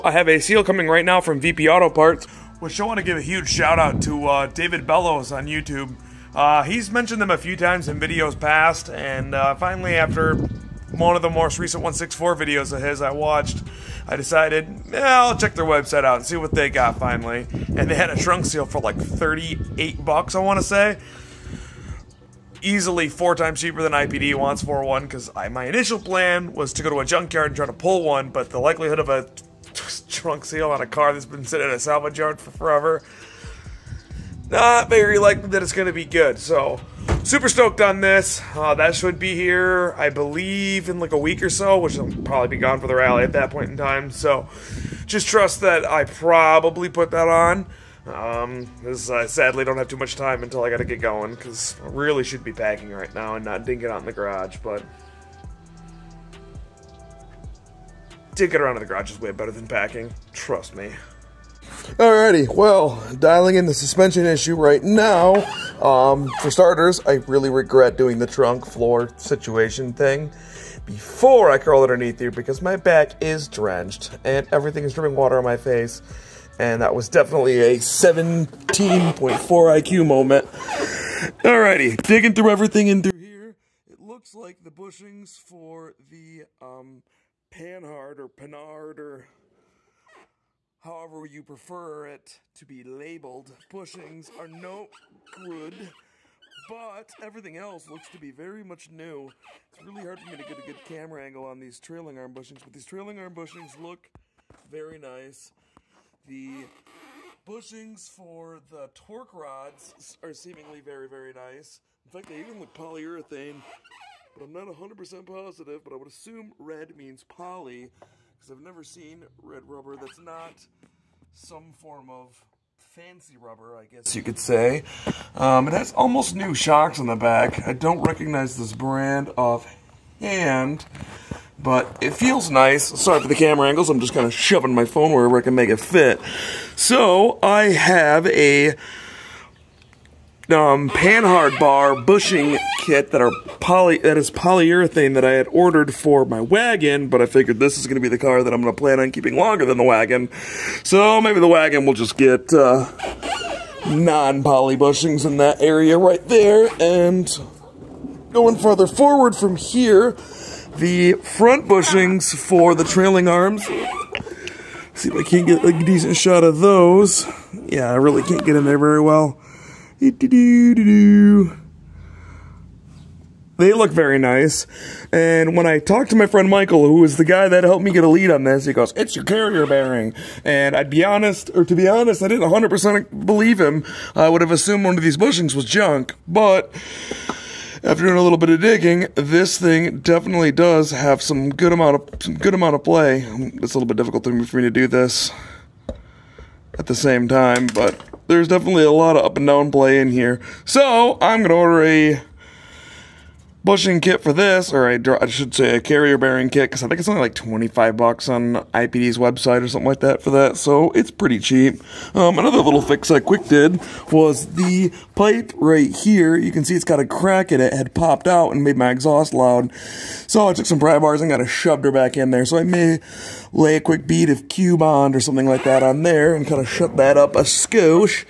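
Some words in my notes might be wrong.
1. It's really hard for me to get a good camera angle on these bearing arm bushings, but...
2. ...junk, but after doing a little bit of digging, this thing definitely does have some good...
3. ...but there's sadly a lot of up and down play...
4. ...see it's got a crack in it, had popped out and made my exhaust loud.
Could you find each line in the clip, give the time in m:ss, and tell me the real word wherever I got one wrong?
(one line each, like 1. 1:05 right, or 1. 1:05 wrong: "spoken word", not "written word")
1. 1:39 wrong: "trailing", not "bearing"
2. 3:05 right
3. 3:17 wrong: "definitely", not "sadly"
4. 3:36 right.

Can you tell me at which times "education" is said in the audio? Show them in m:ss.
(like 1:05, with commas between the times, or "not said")
not said.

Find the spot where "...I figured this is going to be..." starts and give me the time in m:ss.
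2:27.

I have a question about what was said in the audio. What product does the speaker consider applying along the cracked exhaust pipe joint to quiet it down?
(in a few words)
Q-Bond.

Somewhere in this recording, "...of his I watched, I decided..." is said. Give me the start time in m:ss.
0:12.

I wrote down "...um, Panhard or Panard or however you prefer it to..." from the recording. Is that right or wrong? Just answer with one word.
right.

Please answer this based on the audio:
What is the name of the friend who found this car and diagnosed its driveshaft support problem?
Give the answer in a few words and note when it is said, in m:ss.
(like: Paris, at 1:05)
Michael, at 2:56.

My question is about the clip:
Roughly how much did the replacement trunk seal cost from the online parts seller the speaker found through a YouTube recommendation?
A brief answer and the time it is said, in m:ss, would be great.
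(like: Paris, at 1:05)
$38, at 0:18.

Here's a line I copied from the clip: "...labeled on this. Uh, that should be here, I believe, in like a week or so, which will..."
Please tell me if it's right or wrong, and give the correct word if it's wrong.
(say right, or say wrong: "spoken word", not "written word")
wrong: "stoked", not "labeled".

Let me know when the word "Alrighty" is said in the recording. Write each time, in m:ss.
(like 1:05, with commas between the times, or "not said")
1:01, 1:21.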